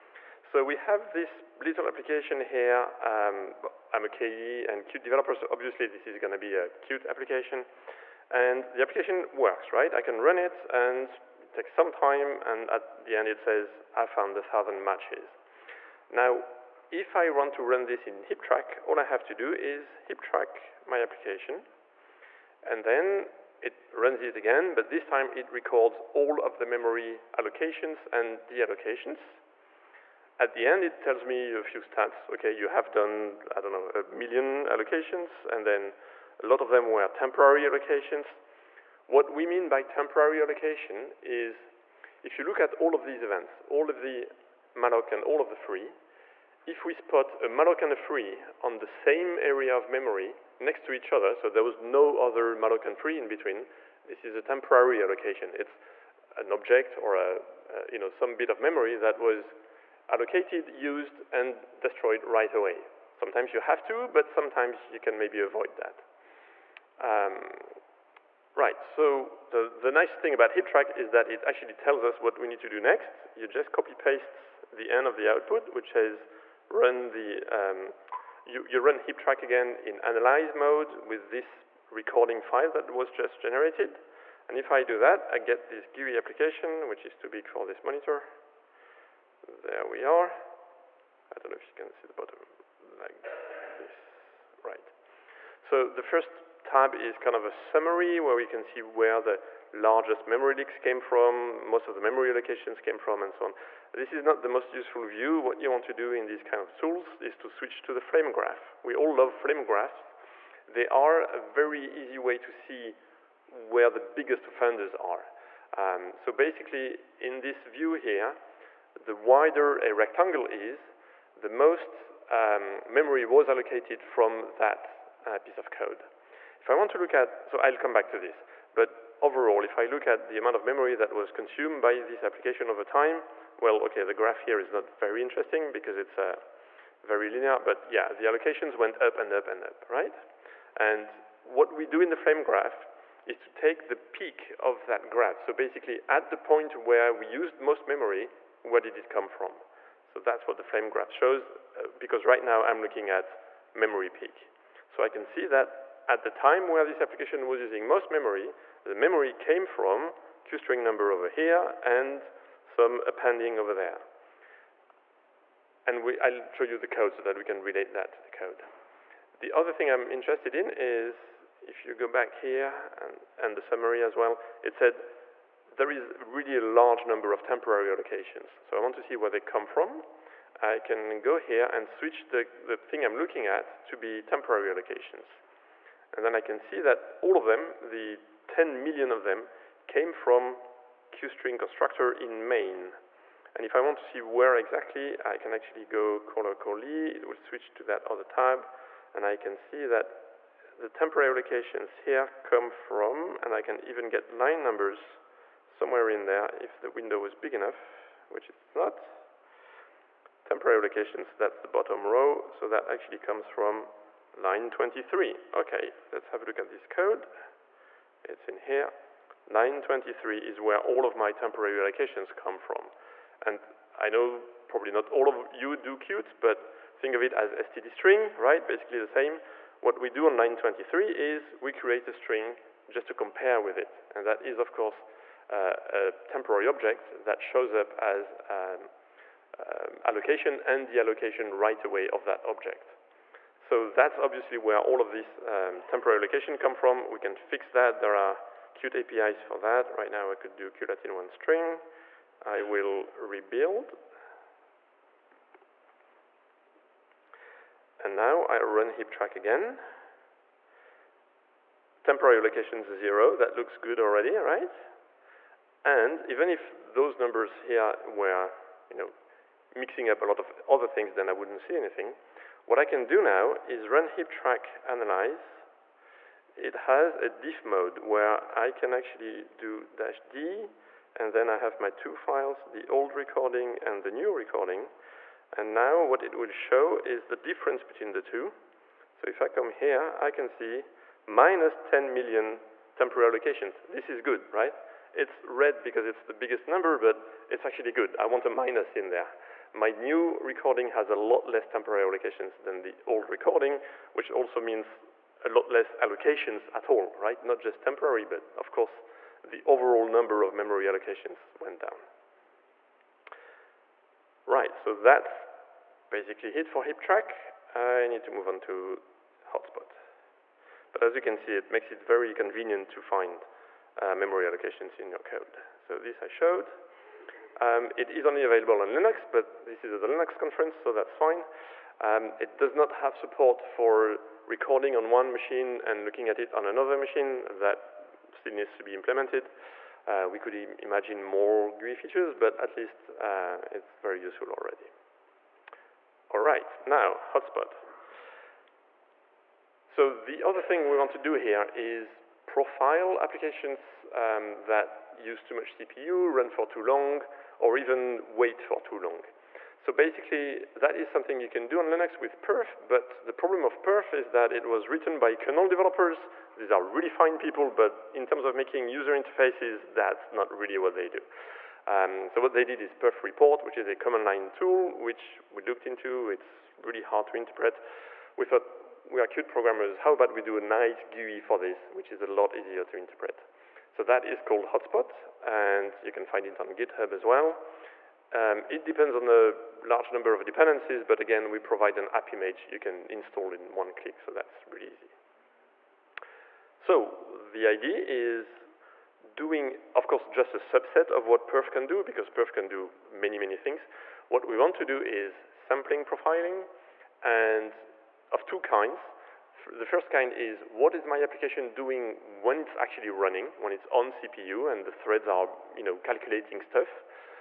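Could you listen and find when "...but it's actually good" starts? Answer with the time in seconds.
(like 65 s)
296 s.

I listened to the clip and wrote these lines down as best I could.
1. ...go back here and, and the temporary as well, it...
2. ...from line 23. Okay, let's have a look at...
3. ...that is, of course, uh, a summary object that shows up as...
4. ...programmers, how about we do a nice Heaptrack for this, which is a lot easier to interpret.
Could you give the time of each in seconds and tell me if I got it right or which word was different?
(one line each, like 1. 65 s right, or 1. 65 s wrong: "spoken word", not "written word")
1. 171 s wrong: "summary", not "temporary"
2. 213 s right
3. 234 s wrong: "temporary", not "summary"
4. 379 s wrong: "GUI", not "Heaptrack".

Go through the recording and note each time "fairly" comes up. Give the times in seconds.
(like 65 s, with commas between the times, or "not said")
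not said.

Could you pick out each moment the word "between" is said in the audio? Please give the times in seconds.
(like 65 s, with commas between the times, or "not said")
53 s, 287 s.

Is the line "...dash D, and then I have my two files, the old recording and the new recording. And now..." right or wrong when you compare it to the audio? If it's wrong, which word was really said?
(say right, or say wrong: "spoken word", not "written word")
right.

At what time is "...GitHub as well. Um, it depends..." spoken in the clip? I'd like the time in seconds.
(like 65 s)
386 s.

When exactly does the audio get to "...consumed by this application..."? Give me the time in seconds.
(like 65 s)
131 s.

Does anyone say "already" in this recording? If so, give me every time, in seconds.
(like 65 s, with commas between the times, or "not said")
263 s, 344 s.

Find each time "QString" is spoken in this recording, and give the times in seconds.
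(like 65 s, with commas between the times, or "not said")
160 s, 191 s.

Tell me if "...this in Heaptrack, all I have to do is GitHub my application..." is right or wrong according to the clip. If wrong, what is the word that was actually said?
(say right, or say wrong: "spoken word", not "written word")
wrong: "Heaptrack", not "GitHub".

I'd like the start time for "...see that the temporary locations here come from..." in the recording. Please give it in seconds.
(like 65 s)
199 s.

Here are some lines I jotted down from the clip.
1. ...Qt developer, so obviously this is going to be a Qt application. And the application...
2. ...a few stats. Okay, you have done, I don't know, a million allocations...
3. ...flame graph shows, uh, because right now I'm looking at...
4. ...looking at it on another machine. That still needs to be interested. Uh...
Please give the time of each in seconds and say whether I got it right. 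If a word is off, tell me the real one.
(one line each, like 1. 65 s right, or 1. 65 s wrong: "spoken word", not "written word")
1. 4 s right
2. 31 s right
3. 150 s right
4. 336 s wrong: "implemented", not "interested".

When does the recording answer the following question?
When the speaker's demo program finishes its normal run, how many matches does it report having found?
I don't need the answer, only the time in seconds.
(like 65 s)
14 s.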